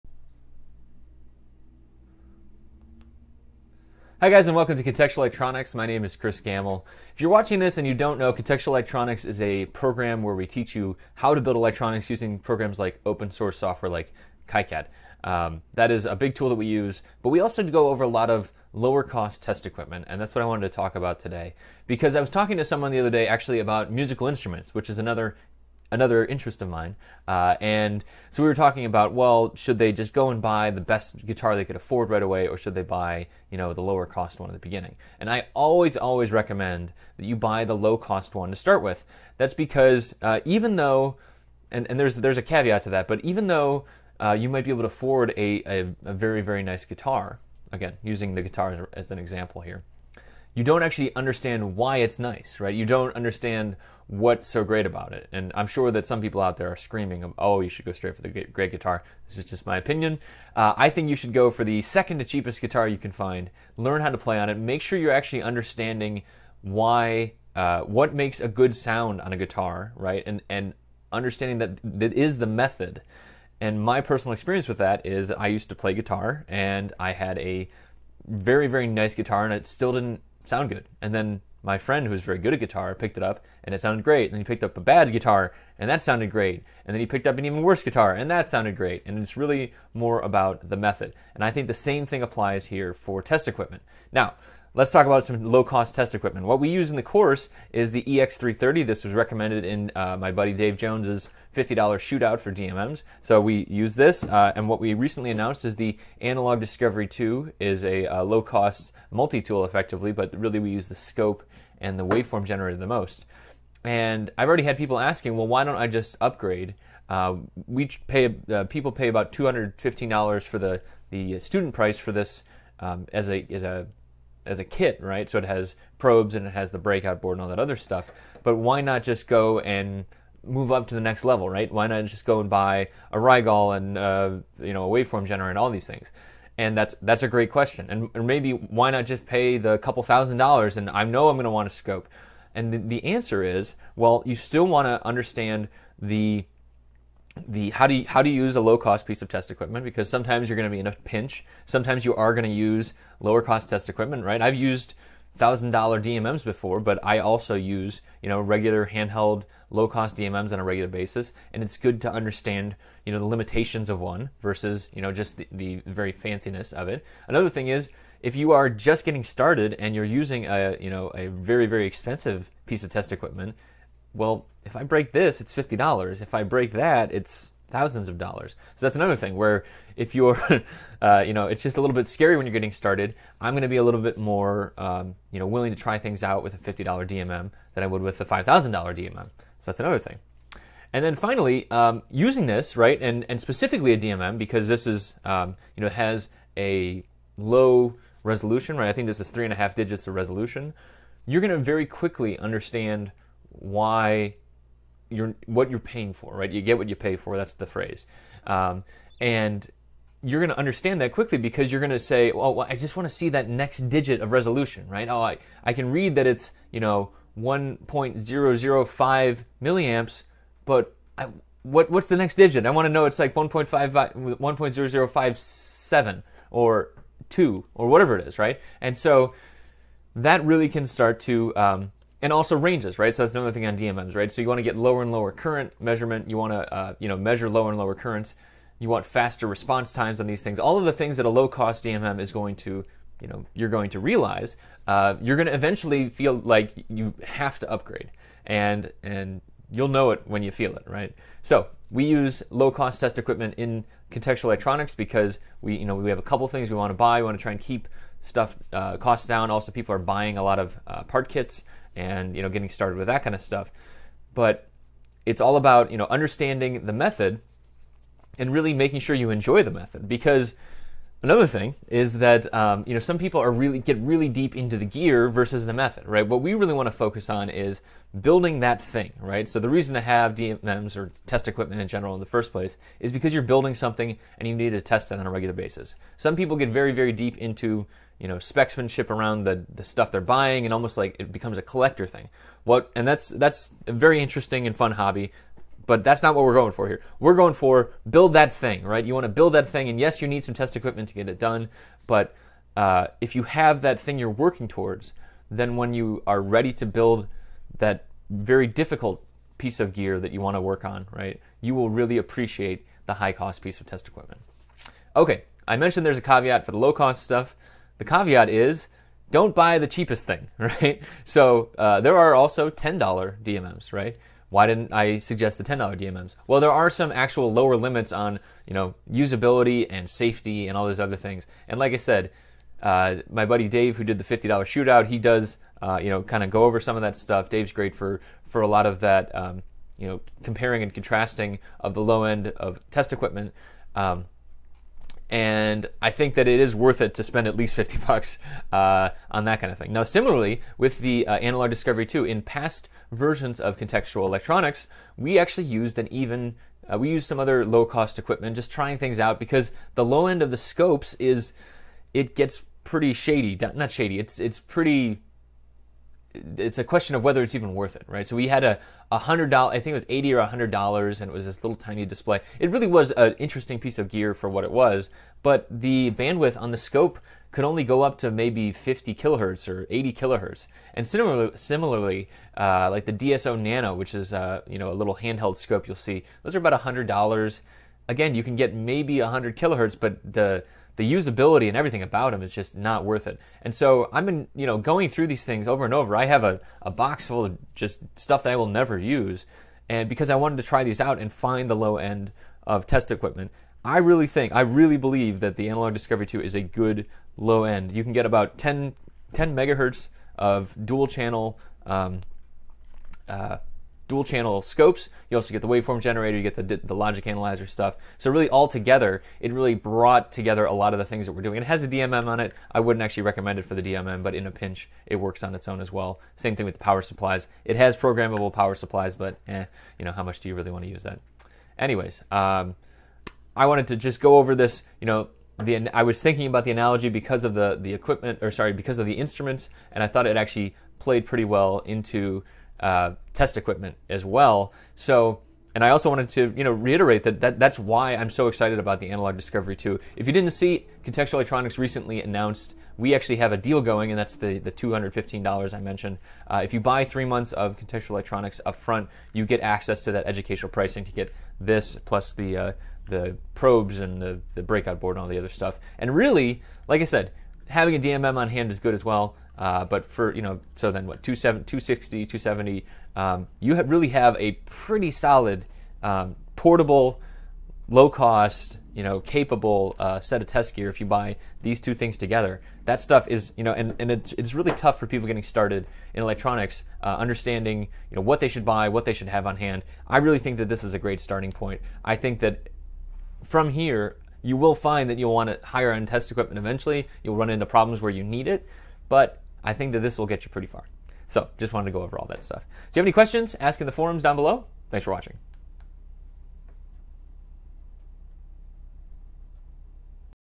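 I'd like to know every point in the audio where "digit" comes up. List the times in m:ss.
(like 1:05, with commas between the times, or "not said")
3:19, 3:33, 3:42.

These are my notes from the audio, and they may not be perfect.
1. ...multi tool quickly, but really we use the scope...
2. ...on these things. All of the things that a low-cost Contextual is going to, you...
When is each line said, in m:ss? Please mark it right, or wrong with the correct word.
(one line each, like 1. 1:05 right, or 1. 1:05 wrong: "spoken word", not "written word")
1. 1:49 wrong: "effectively", not "quickly"
2. 4:00 wrong: "DMM", not "Contextual".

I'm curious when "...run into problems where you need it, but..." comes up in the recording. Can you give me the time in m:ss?
8:17.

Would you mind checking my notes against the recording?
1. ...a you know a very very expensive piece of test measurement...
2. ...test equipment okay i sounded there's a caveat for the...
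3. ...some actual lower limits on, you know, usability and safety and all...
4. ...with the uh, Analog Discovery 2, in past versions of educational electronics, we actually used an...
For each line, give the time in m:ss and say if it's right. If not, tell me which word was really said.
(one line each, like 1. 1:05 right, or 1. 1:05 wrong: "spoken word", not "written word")
1. 2:50 wrong: "equipment", not "measurement"
2. 5:13 wrong: "mentioned", not "sounded"
3. 5:26 right
4. 5:50 wrong: "contextual", not "educational".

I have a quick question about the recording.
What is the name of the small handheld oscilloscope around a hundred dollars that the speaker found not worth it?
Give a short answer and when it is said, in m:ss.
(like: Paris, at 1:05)
DSO Nano, at 6:23.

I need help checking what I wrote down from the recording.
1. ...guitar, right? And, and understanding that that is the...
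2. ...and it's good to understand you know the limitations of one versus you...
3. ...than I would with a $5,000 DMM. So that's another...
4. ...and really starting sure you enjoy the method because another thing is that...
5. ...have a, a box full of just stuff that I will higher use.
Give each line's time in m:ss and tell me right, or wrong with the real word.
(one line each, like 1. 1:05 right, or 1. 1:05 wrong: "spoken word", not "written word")
1. 1:09 right
2. 2:41 right
3. 3:07 right
4. 4:28 wrong: "making", not "starting"
5. 6:36 wrong: "never", not "higher".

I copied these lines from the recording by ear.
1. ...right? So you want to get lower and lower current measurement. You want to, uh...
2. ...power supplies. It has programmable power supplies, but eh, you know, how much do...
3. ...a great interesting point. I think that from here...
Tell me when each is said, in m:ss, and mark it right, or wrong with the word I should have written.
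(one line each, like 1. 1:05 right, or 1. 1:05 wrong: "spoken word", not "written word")
1. 3:54 right
2. 7:06 right
3. 8:10 wrong: "starting", not "interesting".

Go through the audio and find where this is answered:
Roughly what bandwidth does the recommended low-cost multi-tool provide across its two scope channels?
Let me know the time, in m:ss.
6:49.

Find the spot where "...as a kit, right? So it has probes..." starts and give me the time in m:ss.
2:04.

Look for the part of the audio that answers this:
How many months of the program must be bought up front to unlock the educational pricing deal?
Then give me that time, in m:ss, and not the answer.
7:37.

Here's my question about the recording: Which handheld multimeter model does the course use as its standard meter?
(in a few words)
EX330.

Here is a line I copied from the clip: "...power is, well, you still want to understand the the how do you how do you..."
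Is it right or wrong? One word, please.
wrong.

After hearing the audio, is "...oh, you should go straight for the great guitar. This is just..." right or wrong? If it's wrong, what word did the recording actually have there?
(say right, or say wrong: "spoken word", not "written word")
right.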